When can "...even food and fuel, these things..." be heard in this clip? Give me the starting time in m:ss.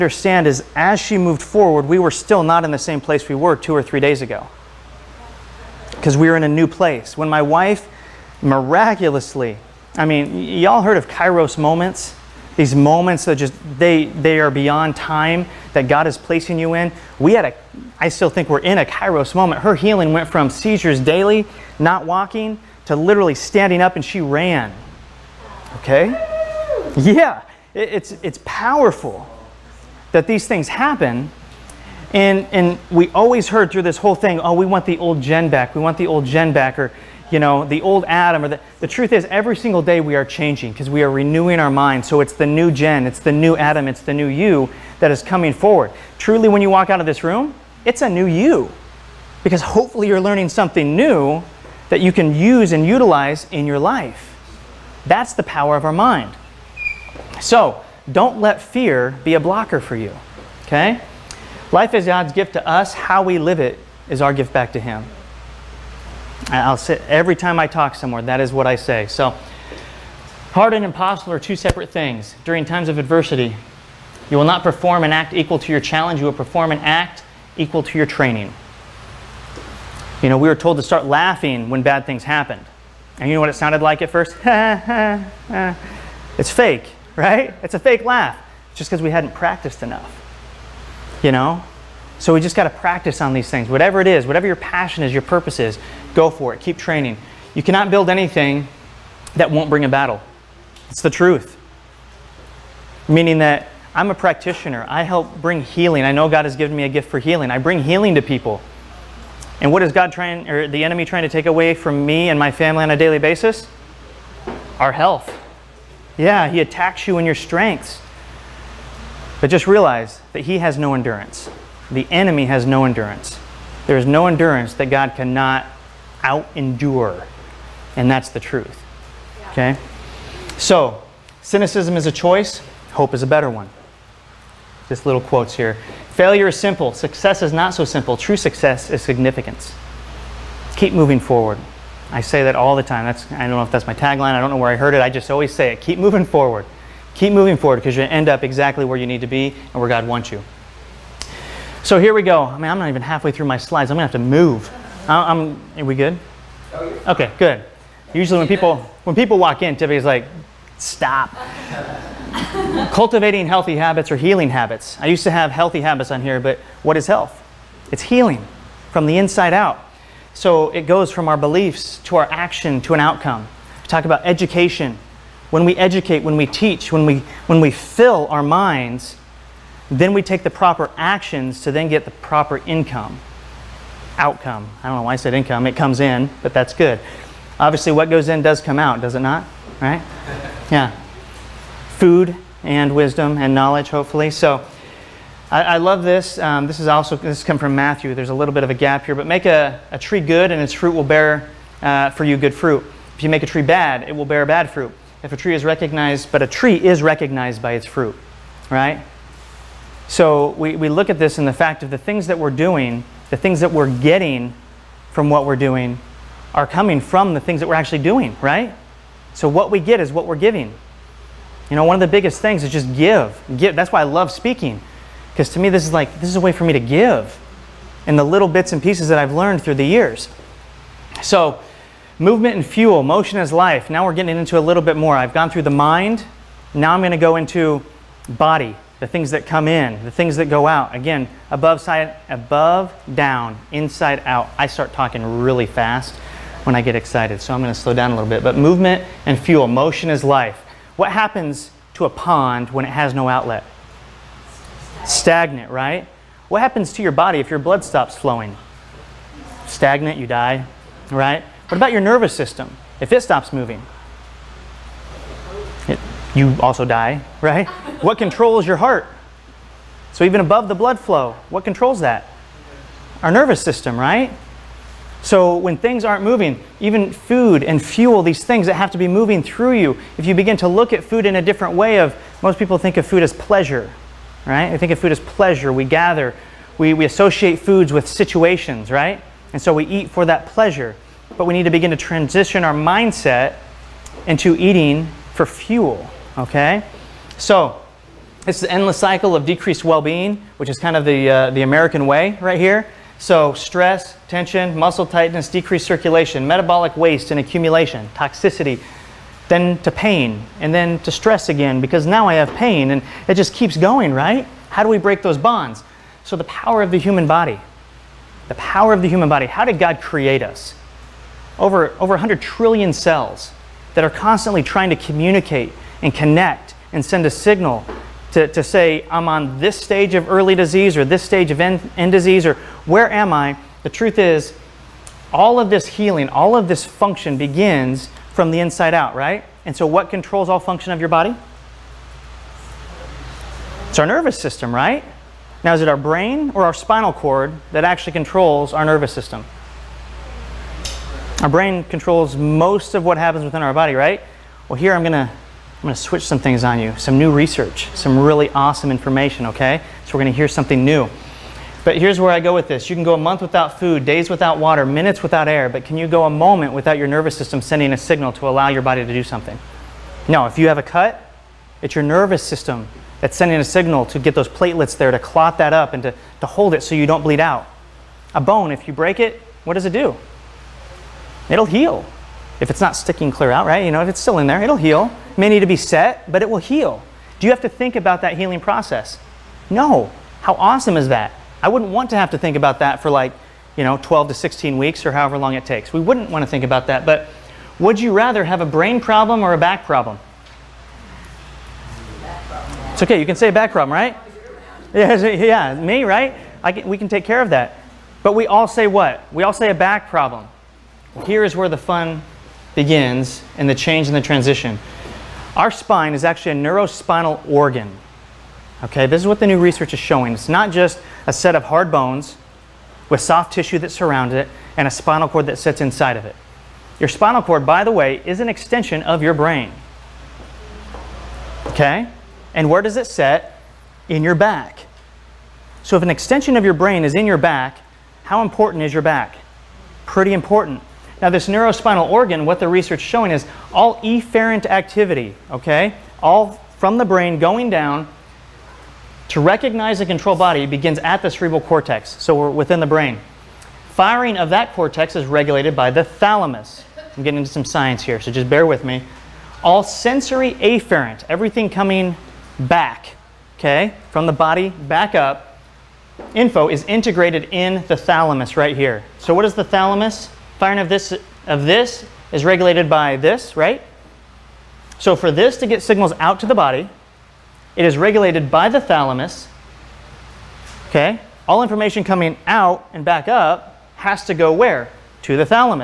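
4:36.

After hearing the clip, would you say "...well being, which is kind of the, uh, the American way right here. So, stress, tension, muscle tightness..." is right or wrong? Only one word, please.
right.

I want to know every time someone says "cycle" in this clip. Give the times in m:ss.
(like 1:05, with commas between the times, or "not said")
4:58.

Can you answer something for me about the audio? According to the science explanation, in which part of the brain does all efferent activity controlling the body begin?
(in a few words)
cerebral cortex.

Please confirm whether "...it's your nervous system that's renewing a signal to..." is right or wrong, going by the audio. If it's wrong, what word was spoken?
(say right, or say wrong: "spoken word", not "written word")
wrong: "sending", not "renewing".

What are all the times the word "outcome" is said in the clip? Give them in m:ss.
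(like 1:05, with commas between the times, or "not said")
2:52, 3:04.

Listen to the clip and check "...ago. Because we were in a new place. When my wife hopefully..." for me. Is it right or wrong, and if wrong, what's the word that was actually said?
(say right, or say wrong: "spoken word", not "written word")
wrong: "miraculously", not "hopefully".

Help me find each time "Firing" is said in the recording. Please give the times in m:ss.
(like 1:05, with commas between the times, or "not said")
7:33, 7:50.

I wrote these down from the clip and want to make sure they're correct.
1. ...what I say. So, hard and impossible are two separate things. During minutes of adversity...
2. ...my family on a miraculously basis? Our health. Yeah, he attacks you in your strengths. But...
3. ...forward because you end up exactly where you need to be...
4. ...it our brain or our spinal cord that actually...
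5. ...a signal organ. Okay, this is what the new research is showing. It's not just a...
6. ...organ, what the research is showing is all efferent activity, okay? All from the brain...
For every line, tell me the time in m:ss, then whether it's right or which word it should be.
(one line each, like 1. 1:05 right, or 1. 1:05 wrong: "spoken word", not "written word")
1. 1:08 wrong: "times", not "minutes"
2. 1:52 wrong: "daily", not "miraculously"
3. 2:27 right
4. 5:45 right
5. 6:56 wrong: "neurospinal", not "signal"
6. 7:22 right.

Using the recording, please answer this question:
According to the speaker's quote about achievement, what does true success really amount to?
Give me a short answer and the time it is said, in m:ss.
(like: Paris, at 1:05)
significance, at 2:18.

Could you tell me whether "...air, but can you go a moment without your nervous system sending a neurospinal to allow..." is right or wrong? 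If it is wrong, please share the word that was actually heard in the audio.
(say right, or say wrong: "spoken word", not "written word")
wrong: "signal", not "neurospinal".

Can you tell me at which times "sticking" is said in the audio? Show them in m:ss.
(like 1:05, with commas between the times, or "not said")
6:22.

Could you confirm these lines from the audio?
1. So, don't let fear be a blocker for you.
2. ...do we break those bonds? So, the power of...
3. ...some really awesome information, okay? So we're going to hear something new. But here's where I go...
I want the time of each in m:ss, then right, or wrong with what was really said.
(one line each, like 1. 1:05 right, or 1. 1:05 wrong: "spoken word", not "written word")
1. 0:57 right
2. 5:14 right
3. 5:57 right.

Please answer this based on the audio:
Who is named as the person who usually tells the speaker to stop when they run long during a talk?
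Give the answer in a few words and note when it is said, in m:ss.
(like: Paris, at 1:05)
Tiffany, at 2:39.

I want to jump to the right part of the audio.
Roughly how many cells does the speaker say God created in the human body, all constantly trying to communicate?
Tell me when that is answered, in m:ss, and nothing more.
5:21.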